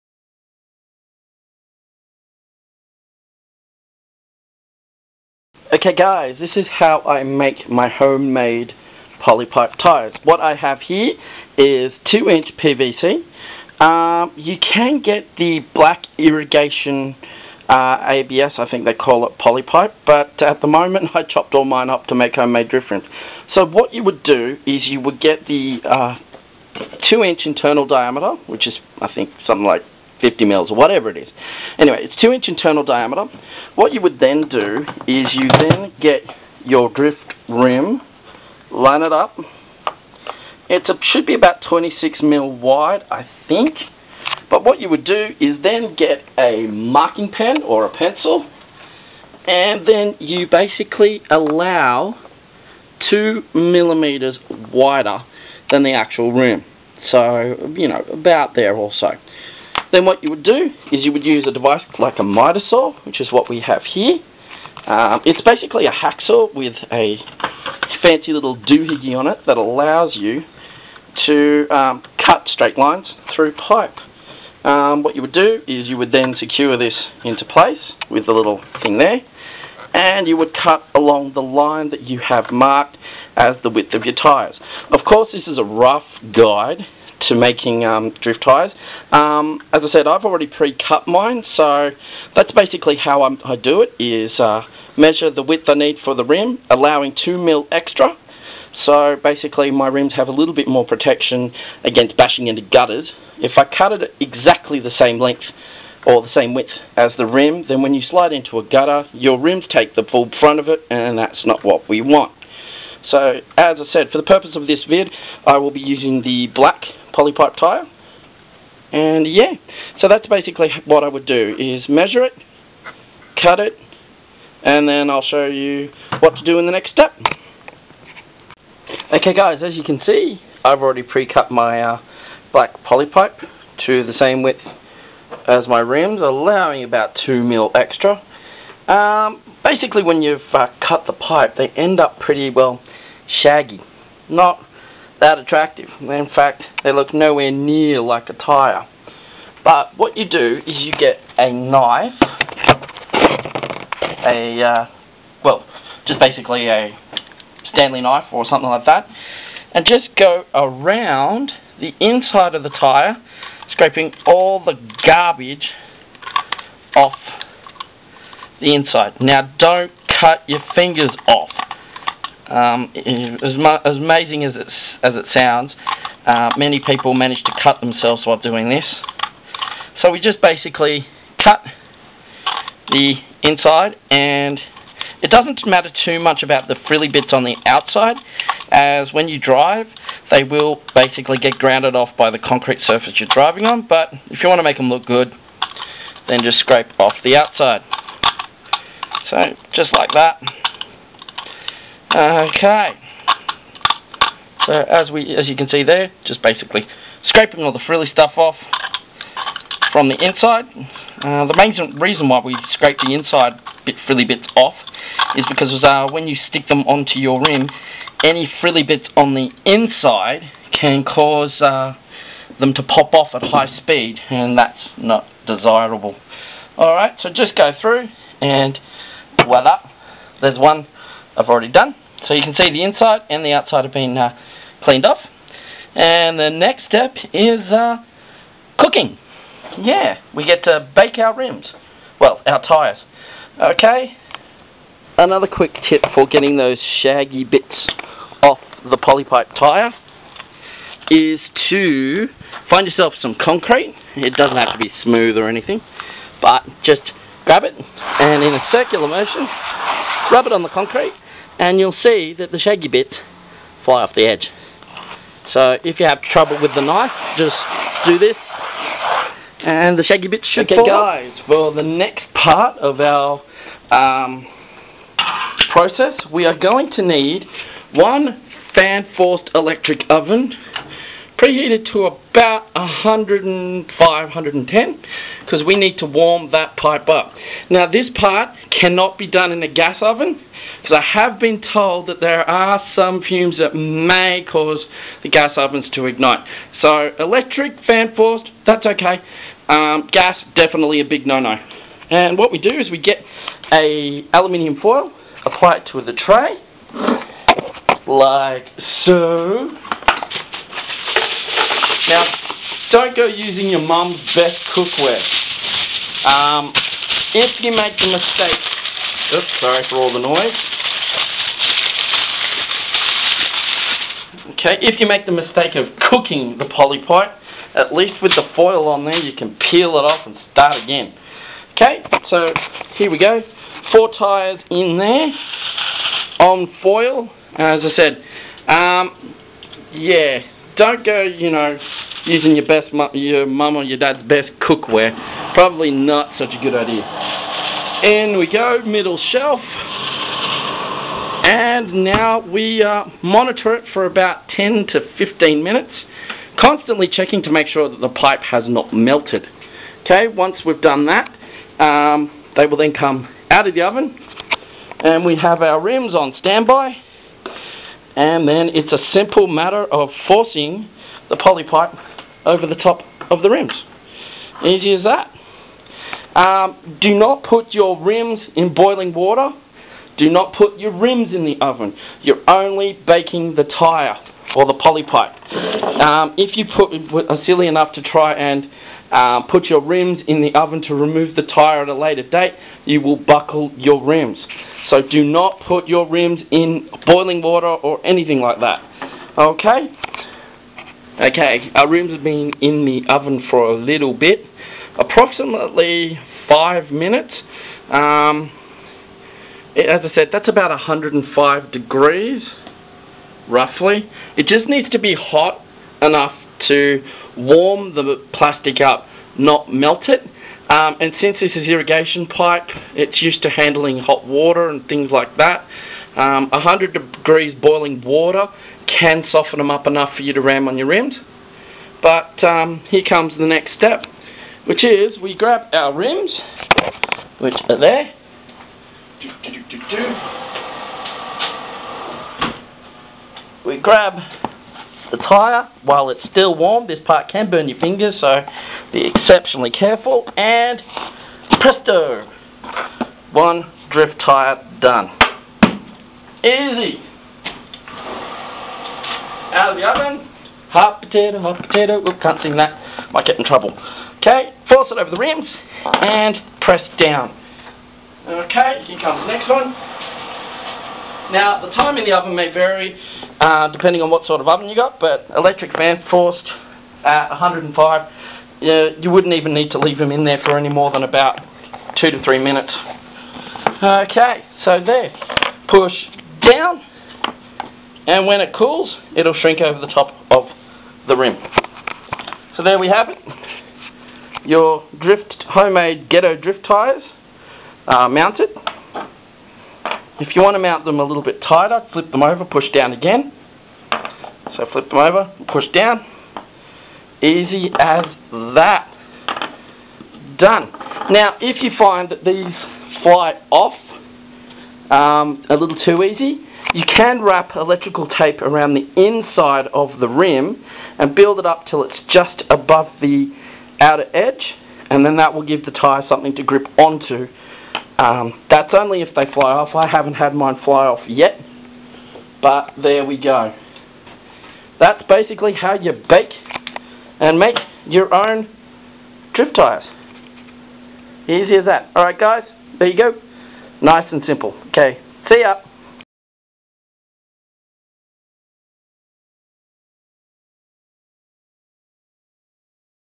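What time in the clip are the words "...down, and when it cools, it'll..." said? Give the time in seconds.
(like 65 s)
486 s.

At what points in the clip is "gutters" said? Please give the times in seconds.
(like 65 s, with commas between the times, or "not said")
102 s, 108 s.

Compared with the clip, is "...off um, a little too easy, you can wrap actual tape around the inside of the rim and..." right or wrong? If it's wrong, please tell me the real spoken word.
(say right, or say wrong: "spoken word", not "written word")
wrong: "electrical", not "actual".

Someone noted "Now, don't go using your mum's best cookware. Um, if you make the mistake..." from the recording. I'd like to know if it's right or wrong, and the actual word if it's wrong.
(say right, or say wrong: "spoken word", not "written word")
right.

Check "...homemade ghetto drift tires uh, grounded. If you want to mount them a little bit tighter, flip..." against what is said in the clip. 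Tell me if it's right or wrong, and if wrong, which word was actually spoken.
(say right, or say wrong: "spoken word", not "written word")
wrong: "mounted", not "grounded".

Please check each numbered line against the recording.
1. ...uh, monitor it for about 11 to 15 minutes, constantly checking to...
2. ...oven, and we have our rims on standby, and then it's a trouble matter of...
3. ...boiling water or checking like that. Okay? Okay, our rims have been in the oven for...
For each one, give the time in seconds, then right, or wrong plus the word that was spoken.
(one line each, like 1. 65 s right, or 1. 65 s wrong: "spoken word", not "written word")
1. 352 s wrong: "10", not "11"
2. 363 s wrong: "simple", not "trouble"
3. 397 s wrong: "anything", not "checking".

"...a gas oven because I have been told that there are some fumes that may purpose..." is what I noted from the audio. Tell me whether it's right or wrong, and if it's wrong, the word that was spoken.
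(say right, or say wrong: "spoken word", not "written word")
wrong: "cause", not "purpose".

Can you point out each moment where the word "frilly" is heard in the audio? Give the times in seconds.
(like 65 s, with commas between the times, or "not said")
186 s, 207 s, 214 s, 218 s.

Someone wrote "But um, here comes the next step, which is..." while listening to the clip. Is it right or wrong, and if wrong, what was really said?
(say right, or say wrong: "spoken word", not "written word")
right.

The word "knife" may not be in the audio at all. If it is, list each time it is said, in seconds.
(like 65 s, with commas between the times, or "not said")
151 s, 158 s, 266 s.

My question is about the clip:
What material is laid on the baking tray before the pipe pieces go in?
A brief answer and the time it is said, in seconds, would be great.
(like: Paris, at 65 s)
aluminium foil, at 304 s.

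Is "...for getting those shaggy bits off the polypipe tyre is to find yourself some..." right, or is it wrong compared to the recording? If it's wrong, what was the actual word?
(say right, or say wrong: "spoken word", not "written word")
right.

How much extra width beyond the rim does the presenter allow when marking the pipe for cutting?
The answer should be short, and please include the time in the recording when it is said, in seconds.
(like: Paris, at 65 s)
2 millimeters, at 53 s.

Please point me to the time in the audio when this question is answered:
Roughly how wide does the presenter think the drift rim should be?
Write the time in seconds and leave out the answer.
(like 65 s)
41 s.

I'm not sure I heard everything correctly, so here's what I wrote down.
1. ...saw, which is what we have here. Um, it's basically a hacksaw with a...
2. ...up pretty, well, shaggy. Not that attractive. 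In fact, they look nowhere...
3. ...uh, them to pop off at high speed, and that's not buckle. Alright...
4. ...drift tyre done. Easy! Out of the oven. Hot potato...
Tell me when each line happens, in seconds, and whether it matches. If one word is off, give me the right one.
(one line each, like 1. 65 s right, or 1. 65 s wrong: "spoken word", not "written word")
1. 62 s right
2. 142 s right
3. 221 s wrong: "desirable", not "buckle"
4. 453 s right.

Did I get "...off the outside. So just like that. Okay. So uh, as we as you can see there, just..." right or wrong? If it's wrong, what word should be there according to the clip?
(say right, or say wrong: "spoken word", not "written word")
right.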